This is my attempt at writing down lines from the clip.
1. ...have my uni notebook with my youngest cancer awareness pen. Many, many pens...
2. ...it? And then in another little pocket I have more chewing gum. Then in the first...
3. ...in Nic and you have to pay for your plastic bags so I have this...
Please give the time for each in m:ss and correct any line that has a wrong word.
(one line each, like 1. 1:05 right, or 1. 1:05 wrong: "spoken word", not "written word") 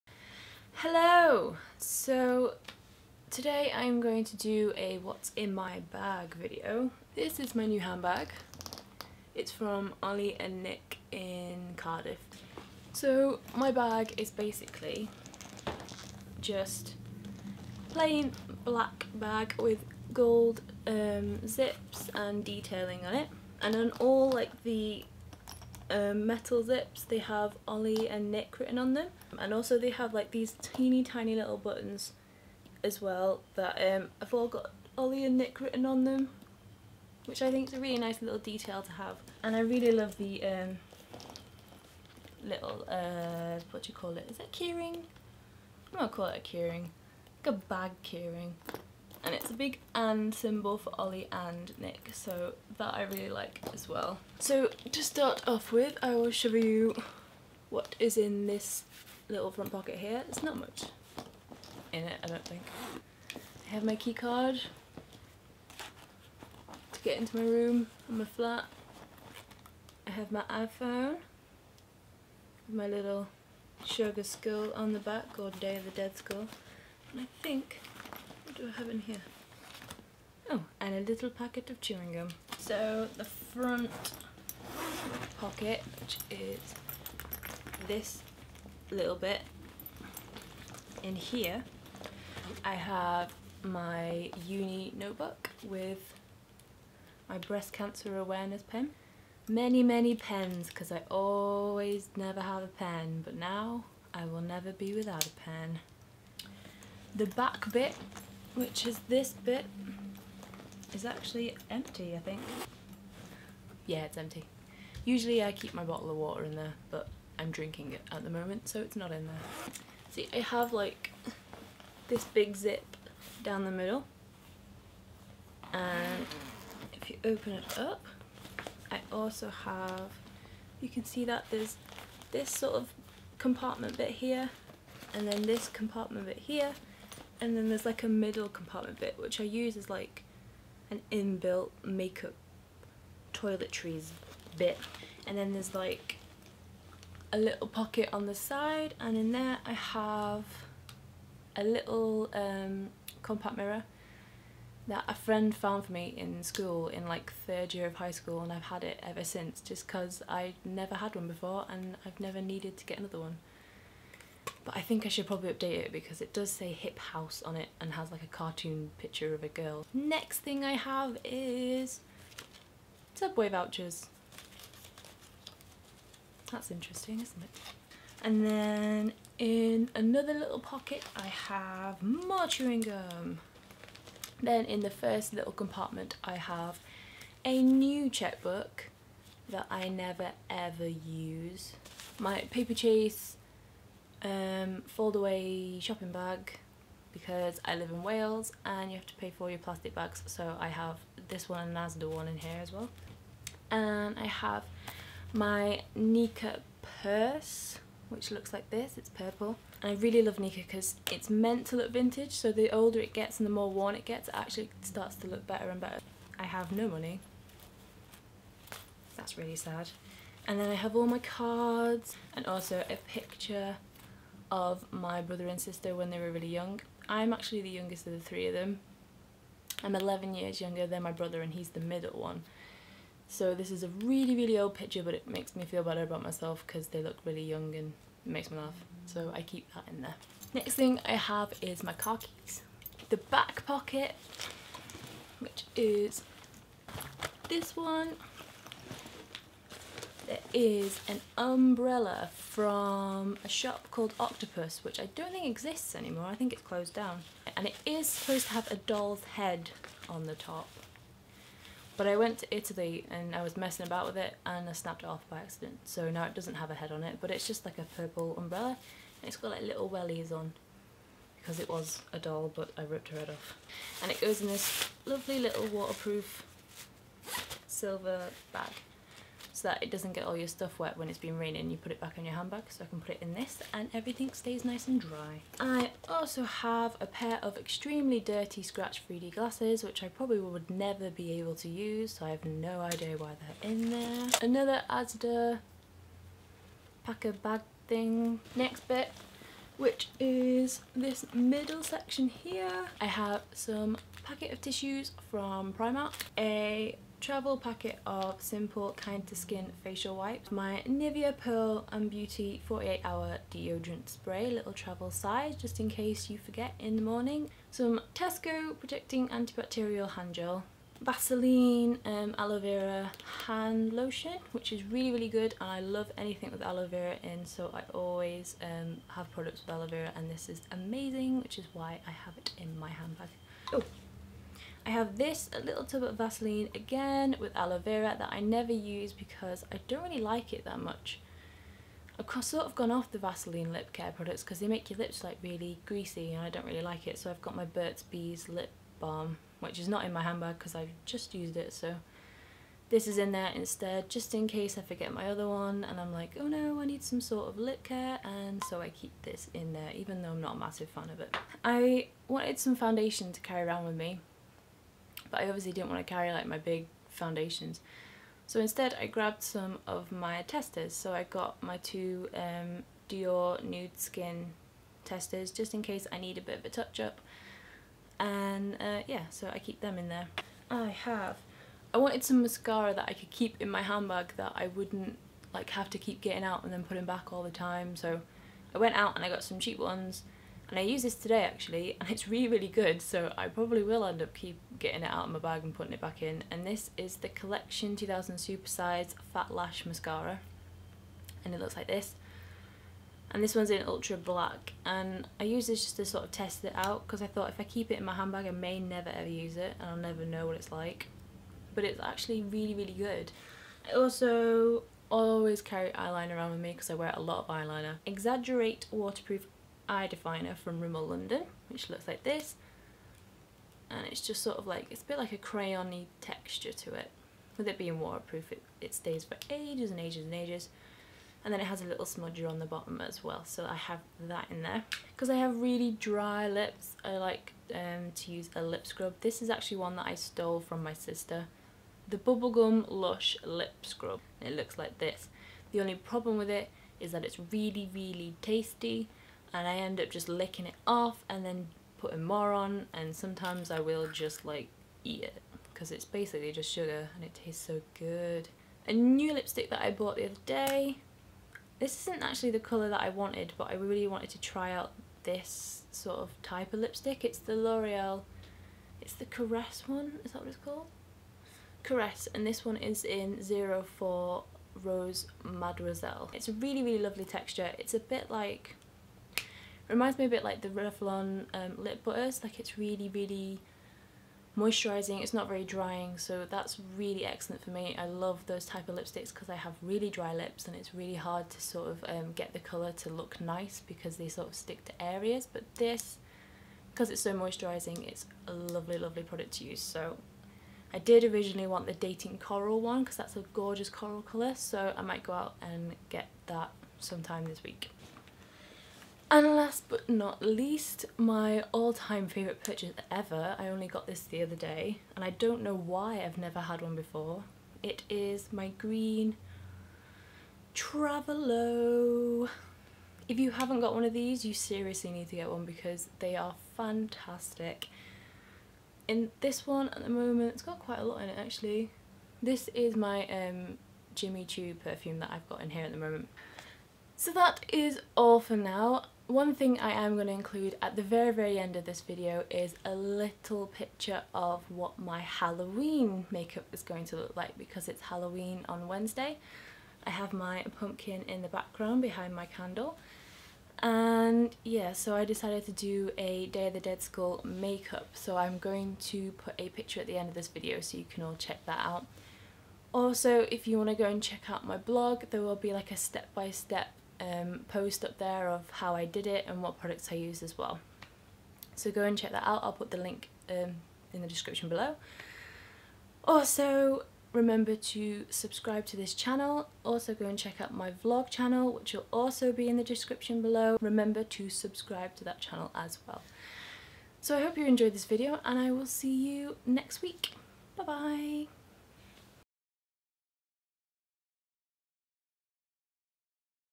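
1. 1:32 wrong: "breast", not "youngest"
2. 2:57 right
3. 3:17 wrong: "Wales", not "Nic".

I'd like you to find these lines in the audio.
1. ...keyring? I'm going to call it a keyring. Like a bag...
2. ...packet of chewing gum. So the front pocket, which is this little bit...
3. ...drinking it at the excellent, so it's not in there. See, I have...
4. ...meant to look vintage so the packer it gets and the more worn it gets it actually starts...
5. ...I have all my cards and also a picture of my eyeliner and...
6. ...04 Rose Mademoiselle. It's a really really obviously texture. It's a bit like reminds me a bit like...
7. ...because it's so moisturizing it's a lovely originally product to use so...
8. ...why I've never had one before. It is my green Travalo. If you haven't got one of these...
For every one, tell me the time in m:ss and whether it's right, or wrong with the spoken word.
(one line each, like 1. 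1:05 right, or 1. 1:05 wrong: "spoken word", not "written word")
1. 0:44 right
2. 1:21 right
3. 1:57 wrong: "moment", not "excellent"
4. 3:31 wrong: "older", not "packer"
5. 3:40 wrong: "brother", not "eyeliner"
6. 7:53 wrong: "lovely", not "obviously"
7. 8:16 wrong: "lovely", not "originally"
8. 8:35 right.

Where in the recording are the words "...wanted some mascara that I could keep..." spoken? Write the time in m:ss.
6:21.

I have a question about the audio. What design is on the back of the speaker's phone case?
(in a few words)
Sugar skull.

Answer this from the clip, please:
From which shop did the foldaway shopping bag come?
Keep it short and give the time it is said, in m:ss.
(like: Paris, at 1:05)
Paperchase, at 3:12.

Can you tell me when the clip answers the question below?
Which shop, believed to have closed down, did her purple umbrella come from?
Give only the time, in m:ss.
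4:14.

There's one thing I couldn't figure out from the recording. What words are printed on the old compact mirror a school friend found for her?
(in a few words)
Hip House.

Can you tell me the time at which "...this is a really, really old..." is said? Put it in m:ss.
3:53.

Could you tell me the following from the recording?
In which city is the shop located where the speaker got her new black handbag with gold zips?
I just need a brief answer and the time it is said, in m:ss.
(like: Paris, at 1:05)
Cardiff, at 0:11.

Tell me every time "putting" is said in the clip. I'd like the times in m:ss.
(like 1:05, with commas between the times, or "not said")
6:26, 6:35, 7:31.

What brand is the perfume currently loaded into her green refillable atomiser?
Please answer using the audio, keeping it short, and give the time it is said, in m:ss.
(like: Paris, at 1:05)
Jimmy Choo, at 8:54.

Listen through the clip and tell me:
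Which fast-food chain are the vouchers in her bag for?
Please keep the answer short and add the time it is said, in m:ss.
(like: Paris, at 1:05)
Subway, at 2:53.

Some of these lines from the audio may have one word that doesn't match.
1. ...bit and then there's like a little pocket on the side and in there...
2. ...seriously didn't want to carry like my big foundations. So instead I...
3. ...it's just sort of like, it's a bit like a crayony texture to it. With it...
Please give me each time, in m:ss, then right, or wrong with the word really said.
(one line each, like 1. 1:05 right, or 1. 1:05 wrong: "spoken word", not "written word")
1. 2:24 right
2. 6:05 wrong: "obviously", not "seriously"
3. 7:04 right.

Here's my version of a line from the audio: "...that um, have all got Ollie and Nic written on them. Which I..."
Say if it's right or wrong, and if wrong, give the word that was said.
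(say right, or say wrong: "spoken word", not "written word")
right.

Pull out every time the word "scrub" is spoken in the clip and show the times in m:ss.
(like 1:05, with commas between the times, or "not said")
7:18, 7:23.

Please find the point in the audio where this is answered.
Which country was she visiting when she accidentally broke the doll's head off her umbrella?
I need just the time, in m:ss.
4:22.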